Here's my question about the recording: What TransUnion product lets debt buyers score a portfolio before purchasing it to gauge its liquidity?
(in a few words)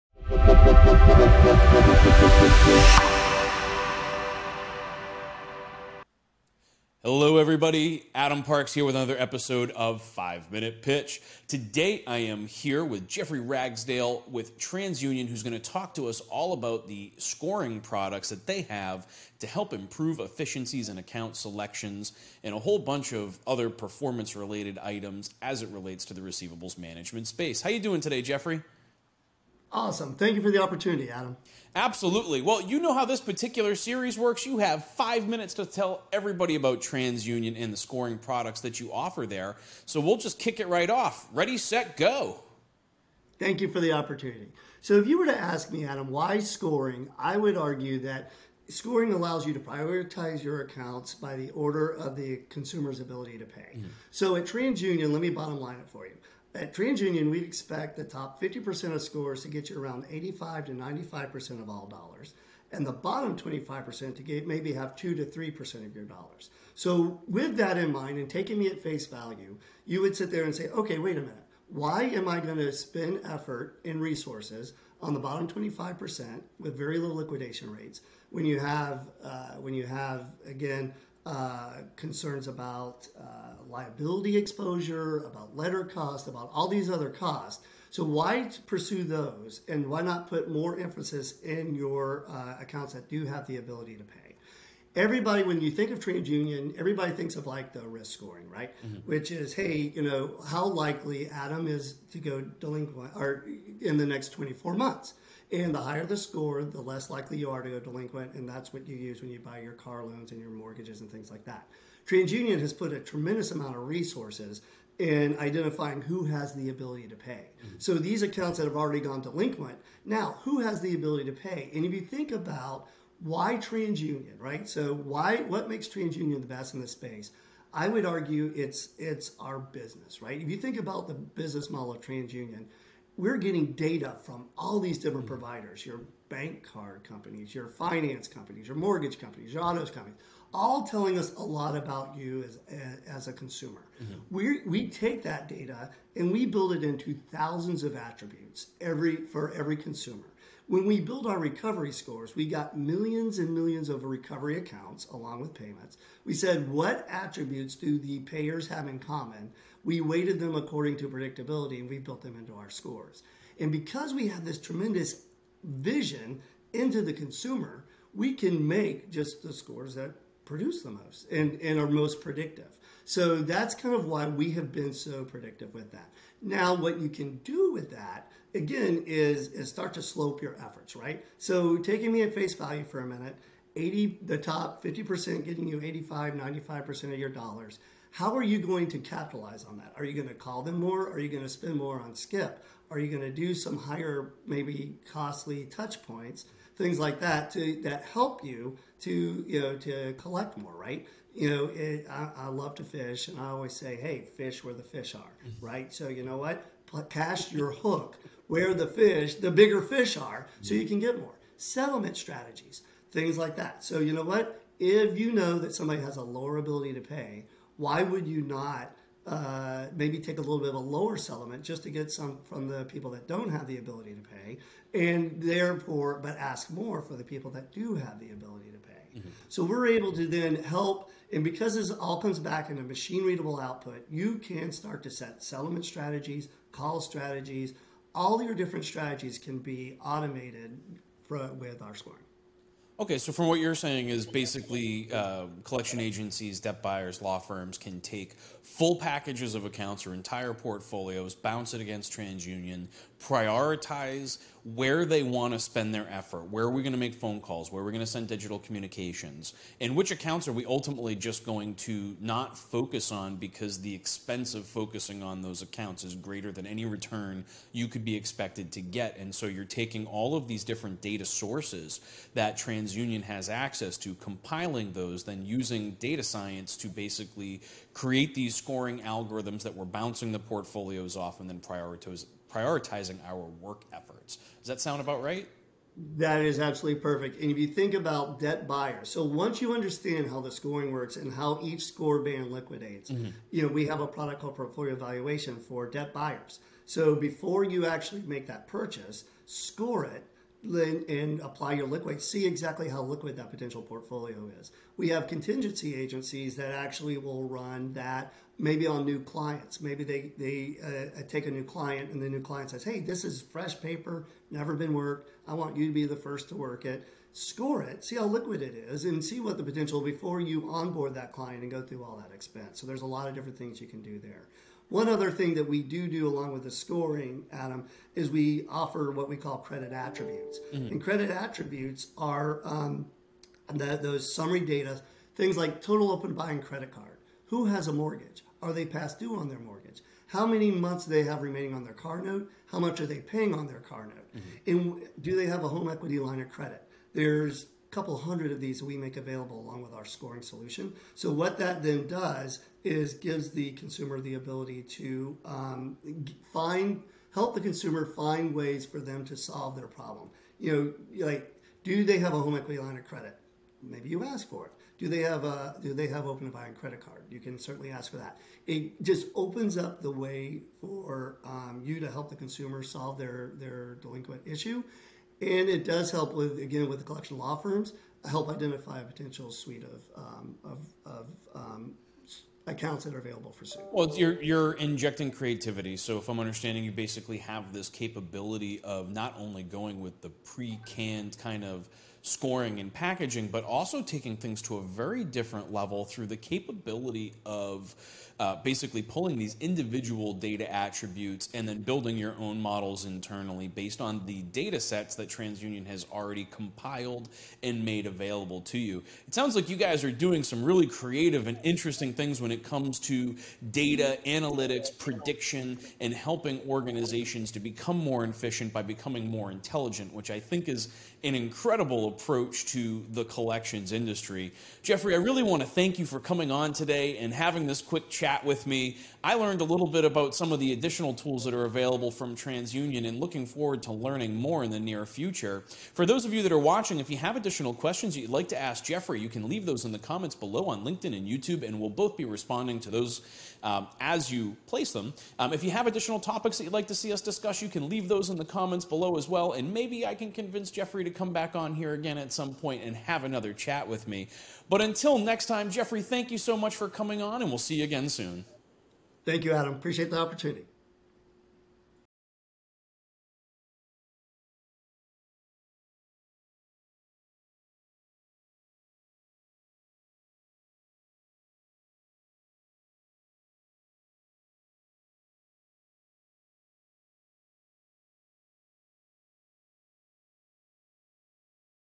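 Portfolio evaluation.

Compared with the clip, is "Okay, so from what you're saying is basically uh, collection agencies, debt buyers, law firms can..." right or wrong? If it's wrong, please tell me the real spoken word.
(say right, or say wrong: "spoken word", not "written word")
right.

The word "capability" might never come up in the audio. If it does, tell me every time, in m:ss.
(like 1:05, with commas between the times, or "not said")
6:27, 6:36.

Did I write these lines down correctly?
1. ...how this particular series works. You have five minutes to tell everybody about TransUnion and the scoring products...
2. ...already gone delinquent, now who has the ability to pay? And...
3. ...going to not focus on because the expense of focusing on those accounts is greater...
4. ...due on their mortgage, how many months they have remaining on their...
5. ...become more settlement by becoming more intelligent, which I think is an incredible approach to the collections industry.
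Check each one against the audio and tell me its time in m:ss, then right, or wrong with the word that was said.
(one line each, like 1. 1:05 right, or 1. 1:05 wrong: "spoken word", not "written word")
1. 0:32 right
2. 1:58 right
3. 4:21 right
4. 5:39 right
5. 6:57 wrong: "efficient", not "settlement".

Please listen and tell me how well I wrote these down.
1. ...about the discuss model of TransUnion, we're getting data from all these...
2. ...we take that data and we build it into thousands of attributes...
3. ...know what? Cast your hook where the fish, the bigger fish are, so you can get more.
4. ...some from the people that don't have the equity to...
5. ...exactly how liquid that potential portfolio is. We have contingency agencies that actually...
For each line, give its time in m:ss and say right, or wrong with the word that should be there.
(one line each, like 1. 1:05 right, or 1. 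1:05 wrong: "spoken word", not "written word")
1. 2:10 wrong: "business", not "discuss"
2. 2:24 right
3. 3:26 right
4. 3:42 wrong: "ability", not "equity"
5. 5:02 right.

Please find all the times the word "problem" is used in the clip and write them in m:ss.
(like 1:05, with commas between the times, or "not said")
5:59.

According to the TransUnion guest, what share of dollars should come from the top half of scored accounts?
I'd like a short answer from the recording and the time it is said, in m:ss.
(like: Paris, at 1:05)
85 to 95%, at 1:00.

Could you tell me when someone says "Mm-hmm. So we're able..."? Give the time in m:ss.
3:49.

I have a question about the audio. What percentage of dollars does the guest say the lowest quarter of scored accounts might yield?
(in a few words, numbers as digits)
2 to 3%.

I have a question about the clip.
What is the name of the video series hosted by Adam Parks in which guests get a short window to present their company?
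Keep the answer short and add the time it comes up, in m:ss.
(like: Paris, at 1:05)
Five Minute Pitch, at 0:10.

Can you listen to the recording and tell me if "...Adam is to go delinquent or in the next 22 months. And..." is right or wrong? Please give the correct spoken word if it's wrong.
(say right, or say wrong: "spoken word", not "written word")
wrong: "24", not "22".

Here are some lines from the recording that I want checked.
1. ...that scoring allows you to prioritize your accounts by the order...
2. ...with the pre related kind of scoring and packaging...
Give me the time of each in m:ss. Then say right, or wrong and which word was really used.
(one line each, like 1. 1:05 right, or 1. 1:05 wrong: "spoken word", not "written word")
1. 0:47 right
2. 6:29 wrong: "canned", not "related".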